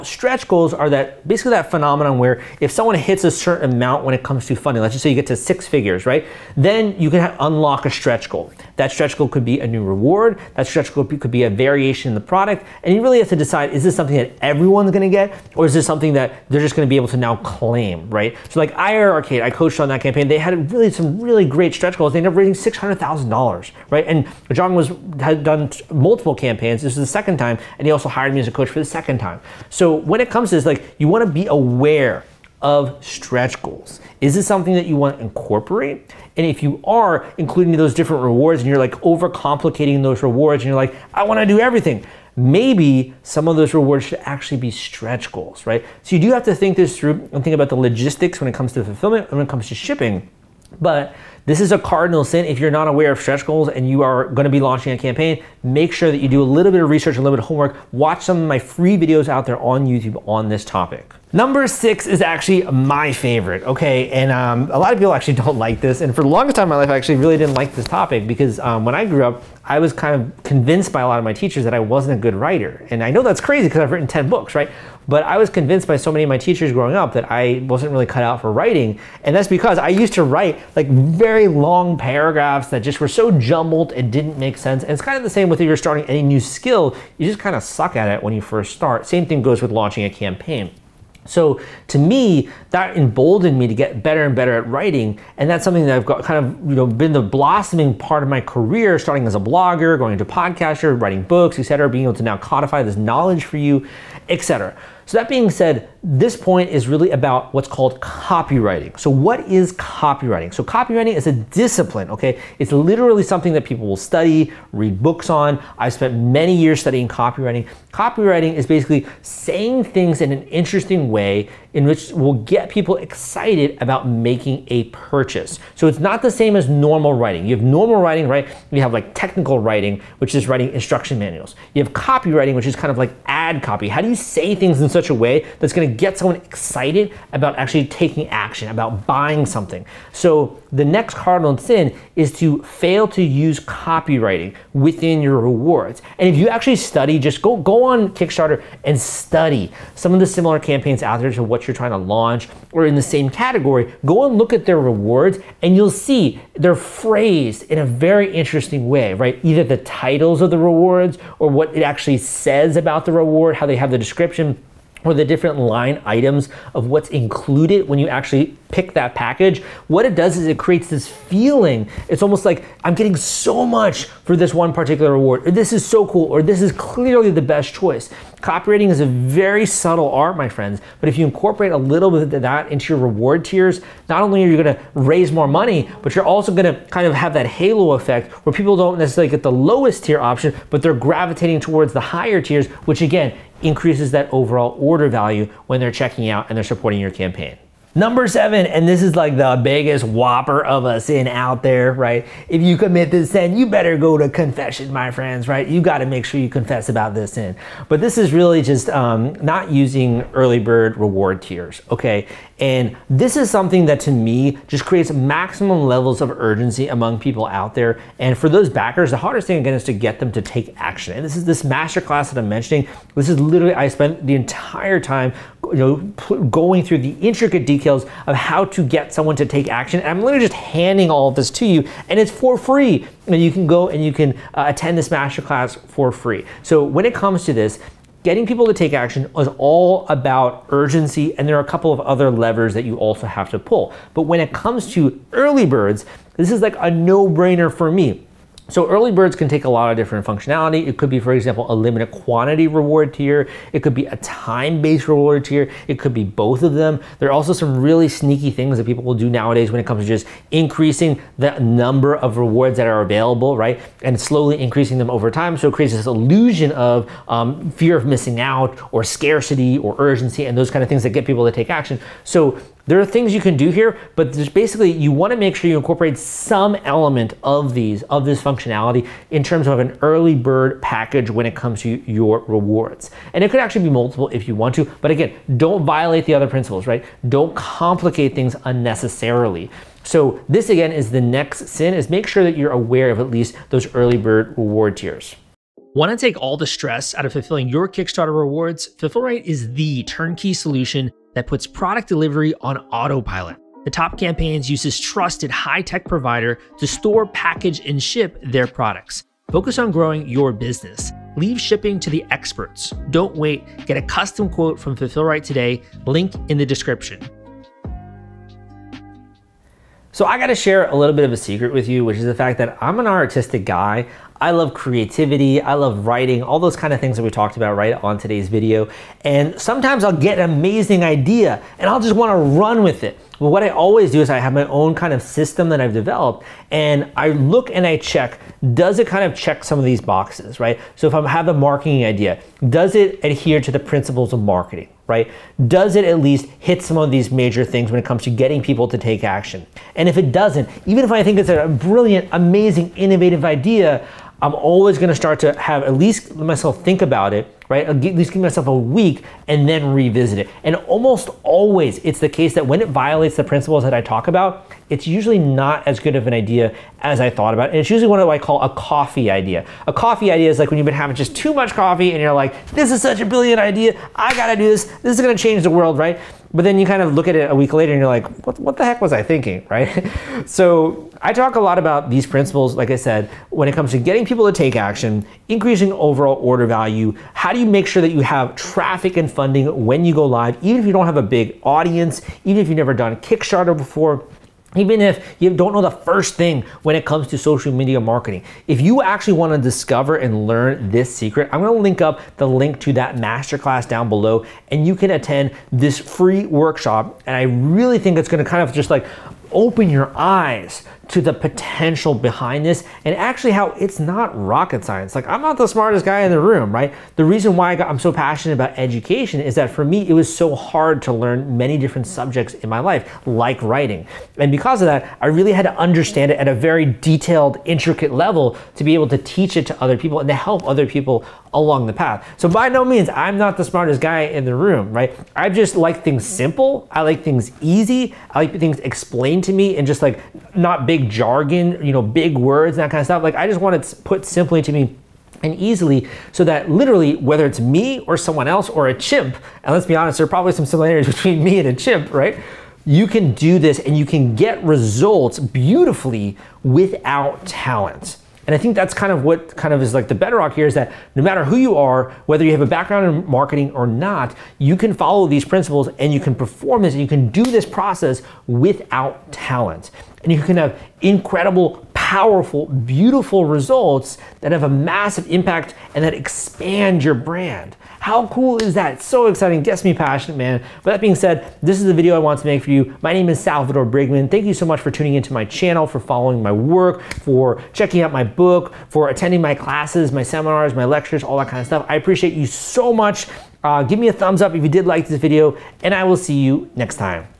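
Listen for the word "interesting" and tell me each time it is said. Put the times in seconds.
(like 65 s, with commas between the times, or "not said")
120 s, 158 s.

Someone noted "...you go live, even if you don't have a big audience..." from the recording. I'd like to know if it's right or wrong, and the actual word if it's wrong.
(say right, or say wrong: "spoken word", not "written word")
right.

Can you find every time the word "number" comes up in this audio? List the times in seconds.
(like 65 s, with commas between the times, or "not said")
61 s, 197 s, 261 s.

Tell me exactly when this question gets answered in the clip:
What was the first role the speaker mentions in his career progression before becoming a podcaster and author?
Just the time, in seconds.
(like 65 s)
99 s.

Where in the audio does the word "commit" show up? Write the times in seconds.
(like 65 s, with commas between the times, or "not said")
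202 s.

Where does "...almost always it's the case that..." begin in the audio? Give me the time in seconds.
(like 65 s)
360 s.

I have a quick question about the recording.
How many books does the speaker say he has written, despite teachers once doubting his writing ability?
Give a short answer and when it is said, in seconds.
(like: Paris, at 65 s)
10, at 74 s.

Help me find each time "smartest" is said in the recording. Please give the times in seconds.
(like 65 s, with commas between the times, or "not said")
415 s, 433 s.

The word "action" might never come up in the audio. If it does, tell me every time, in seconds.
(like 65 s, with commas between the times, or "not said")
138 s, 220 s, 229 s, 238 s, 271 s, 349 s, 384 s.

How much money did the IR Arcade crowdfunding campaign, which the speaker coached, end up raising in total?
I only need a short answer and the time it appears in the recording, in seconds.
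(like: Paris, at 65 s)
$600,000, at 22 s.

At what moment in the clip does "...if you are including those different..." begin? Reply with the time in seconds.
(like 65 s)
36 s.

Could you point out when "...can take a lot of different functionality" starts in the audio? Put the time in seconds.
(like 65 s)
249 s.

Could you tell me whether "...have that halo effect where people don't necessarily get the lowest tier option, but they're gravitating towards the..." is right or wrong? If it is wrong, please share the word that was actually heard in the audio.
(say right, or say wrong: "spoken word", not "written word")
right.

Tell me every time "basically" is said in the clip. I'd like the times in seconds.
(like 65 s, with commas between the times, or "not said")
1 s, 118 s, 274 s.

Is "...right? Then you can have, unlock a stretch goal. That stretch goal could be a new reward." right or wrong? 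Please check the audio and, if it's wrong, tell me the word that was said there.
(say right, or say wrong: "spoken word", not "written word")
right.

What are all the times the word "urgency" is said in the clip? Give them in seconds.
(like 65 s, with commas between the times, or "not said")
216 s, 240 s, 269 s.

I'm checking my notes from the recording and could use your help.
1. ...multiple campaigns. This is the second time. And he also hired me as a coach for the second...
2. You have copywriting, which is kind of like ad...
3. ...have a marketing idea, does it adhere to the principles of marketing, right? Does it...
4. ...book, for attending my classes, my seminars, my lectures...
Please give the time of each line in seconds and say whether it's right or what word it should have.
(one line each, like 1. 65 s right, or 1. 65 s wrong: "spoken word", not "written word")
1. 25 s right
2. 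131 s right
3. 341 s right
4. 488 s right.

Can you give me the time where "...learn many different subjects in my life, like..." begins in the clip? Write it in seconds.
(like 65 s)
421 s.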